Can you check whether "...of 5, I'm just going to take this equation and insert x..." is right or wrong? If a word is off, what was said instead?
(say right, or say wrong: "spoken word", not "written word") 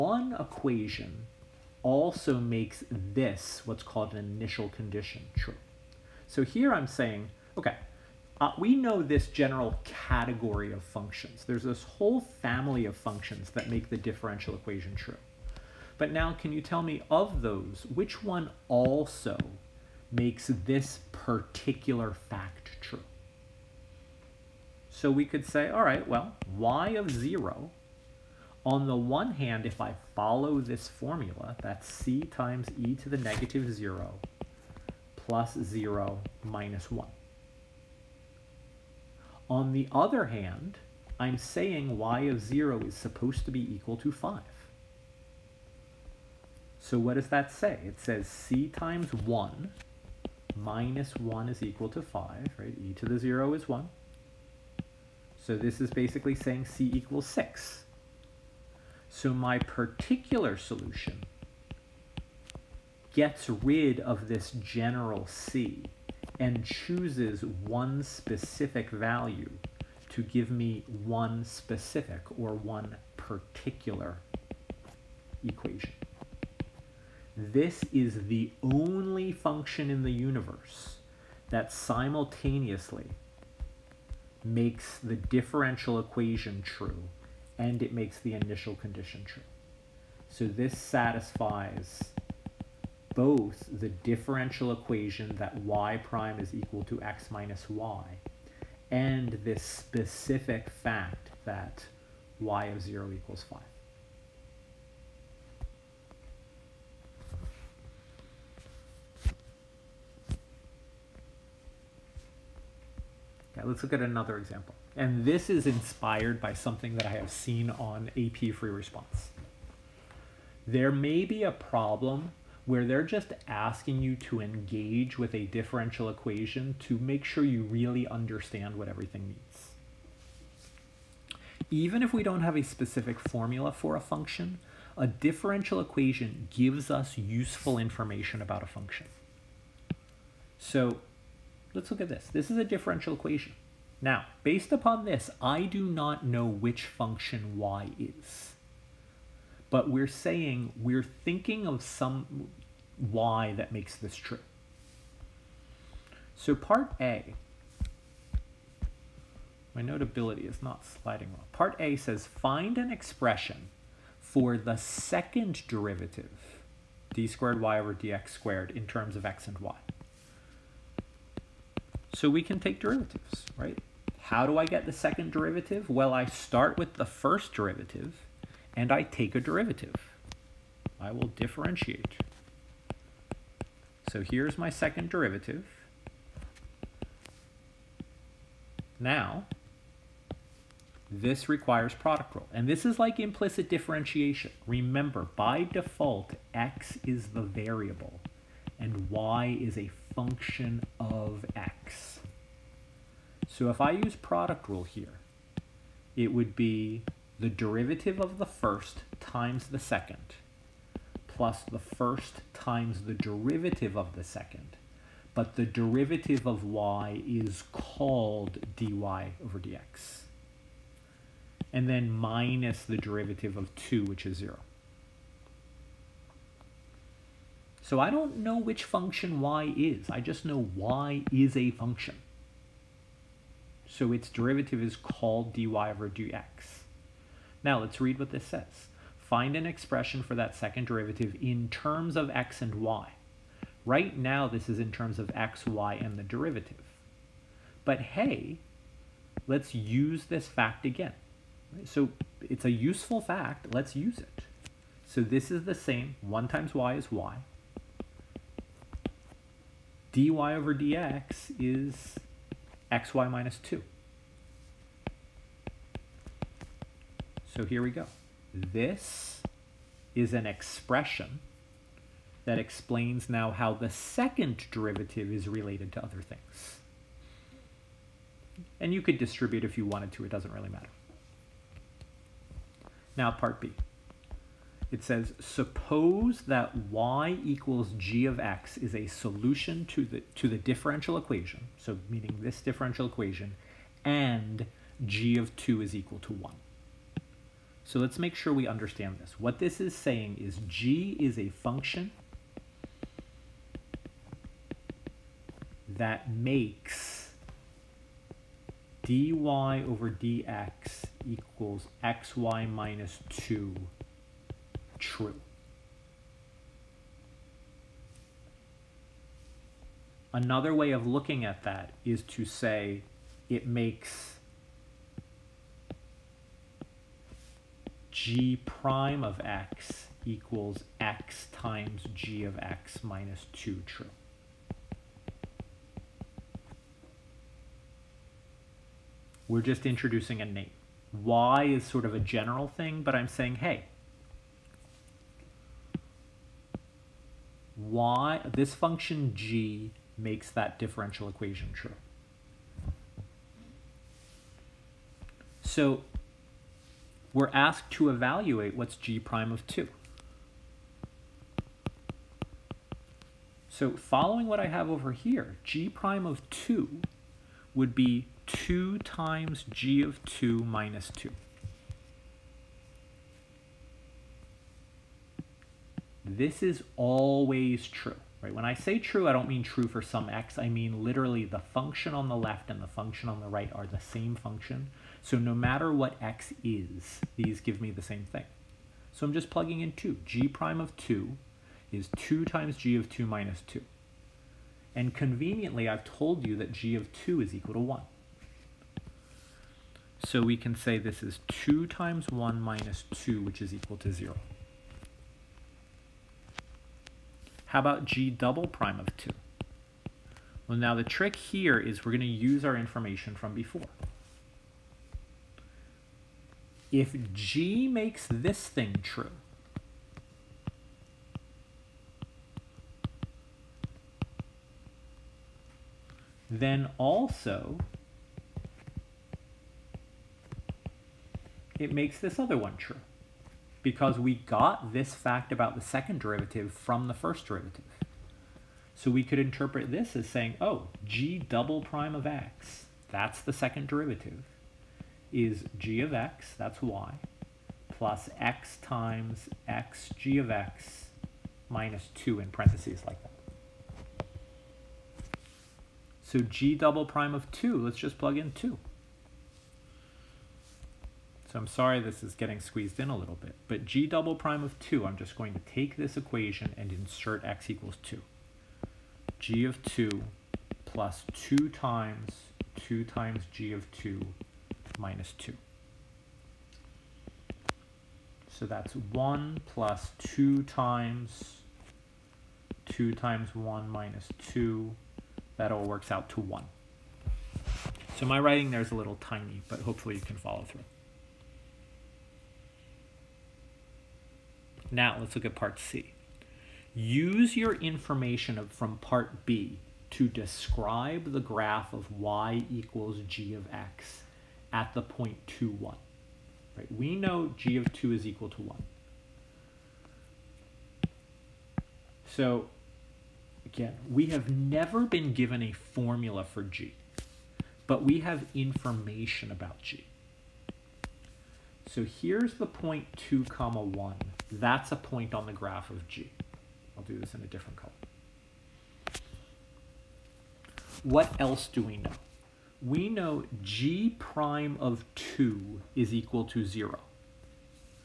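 wrong: "2", not "5".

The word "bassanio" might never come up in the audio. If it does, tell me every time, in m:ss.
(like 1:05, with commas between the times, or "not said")
not said.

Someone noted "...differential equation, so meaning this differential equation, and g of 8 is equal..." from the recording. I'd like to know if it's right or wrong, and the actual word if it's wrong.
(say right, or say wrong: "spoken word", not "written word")
wrong: "2", not "8".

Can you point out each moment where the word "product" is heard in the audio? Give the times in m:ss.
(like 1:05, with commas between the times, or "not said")
3:11, 3:24.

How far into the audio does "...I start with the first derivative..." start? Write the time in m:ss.
2:56.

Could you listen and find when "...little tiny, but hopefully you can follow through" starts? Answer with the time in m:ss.
8:08.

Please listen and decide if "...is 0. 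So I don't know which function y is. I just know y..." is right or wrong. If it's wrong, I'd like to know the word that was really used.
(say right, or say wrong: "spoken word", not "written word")
right.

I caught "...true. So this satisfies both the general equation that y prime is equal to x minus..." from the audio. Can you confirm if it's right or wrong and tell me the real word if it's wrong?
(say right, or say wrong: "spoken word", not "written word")
wrong: "differential", not "general".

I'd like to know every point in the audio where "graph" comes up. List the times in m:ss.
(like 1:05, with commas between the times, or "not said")
8:21, 8:45.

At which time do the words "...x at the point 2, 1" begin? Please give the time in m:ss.
8:23.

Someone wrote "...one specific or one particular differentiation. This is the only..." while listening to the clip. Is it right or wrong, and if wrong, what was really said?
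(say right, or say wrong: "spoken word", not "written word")
wrong: "equation", not "differentiation".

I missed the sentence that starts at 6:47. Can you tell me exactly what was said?
How about g double prime of 2?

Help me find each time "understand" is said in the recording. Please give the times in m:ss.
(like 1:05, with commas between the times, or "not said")
2:08, 4:58.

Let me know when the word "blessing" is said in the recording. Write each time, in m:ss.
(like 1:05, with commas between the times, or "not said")
not said.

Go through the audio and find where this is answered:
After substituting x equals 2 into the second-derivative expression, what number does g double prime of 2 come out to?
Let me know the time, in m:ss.
8:05.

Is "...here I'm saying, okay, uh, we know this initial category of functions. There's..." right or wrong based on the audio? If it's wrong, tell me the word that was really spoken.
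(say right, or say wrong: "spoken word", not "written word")
wrong: "general", not "initial".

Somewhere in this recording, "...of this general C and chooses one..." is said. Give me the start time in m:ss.
1:03.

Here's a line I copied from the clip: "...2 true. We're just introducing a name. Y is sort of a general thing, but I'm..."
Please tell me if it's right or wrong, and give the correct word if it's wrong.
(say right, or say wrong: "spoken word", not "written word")
right.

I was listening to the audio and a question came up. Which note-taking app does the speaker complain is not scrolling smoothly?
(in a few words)
Notability.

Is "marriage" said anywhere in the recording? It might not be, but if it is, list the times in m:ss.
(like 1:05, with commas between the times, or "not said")
not said.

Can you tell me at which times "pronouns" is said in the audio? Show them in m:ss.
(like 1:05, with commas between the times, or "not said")
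not said.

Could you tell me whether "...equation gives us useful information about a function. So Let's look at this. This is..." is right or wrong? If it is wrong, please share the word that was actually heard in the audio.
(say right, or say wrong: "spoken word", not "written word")
right.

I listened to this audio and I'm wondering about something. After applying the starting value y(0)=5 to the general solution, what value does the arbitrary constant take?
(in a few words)
6.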